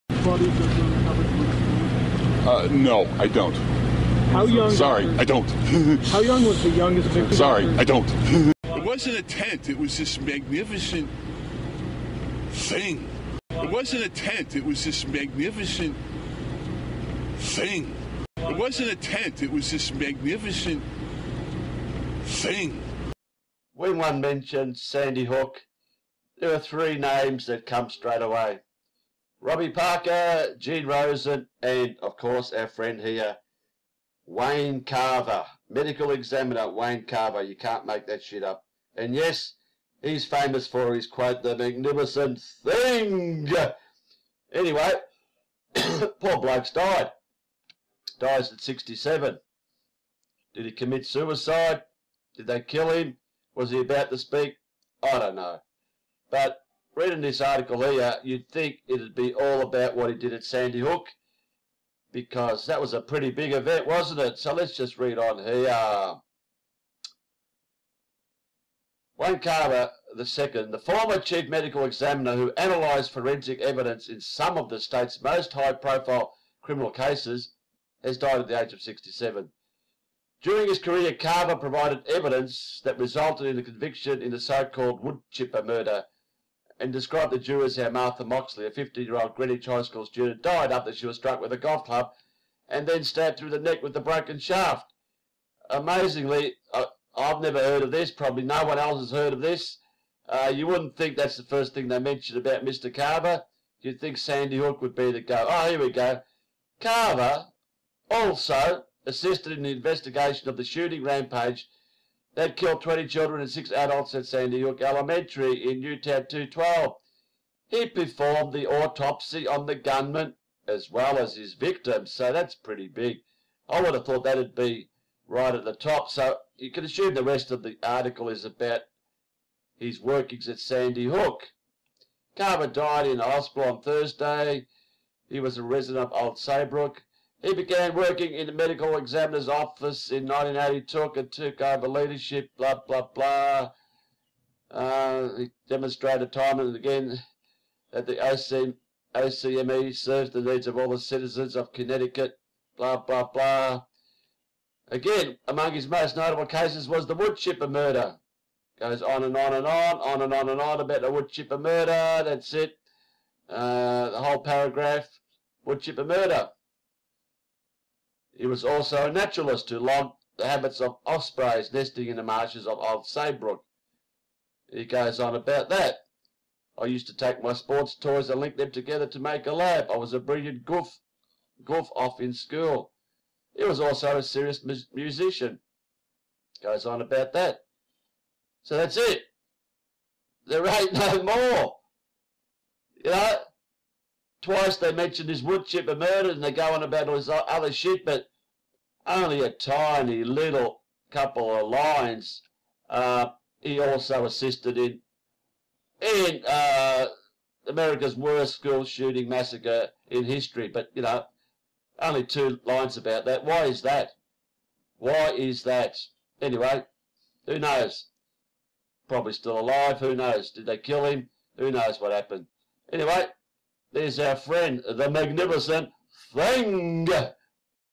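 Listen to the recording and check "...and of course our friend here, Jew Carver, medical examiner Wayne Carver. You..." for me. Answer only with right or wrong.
wrong.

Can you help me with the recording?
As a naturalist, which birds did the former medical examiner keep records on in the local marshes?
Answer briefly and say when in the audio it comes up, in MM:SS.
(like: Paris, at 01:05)
ospreys, at 02:51.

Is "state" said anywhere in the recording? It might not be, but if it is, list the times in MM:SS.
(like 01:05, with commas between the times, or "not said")
01:14.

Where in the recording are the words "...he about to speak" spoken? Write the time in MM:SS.
00:53.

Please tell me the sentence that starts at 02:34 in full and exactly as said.
Again, among his most notable cases was the wood chipper murder.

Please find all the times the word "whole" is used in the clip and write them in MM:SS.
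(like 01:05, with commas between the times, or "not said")
02:44.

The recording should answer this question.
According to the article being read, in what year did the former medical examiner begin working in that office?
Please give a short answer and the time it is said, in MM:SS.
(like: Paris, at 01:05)
1982, at 02:20.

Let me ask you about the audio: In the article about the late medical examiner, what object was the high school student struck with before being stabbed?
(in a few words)
golf club.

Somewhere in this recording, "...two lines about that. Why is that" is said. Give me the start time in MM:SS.
03:32.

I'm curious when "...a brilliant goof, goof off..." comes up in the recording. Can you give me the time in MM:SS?
03:00.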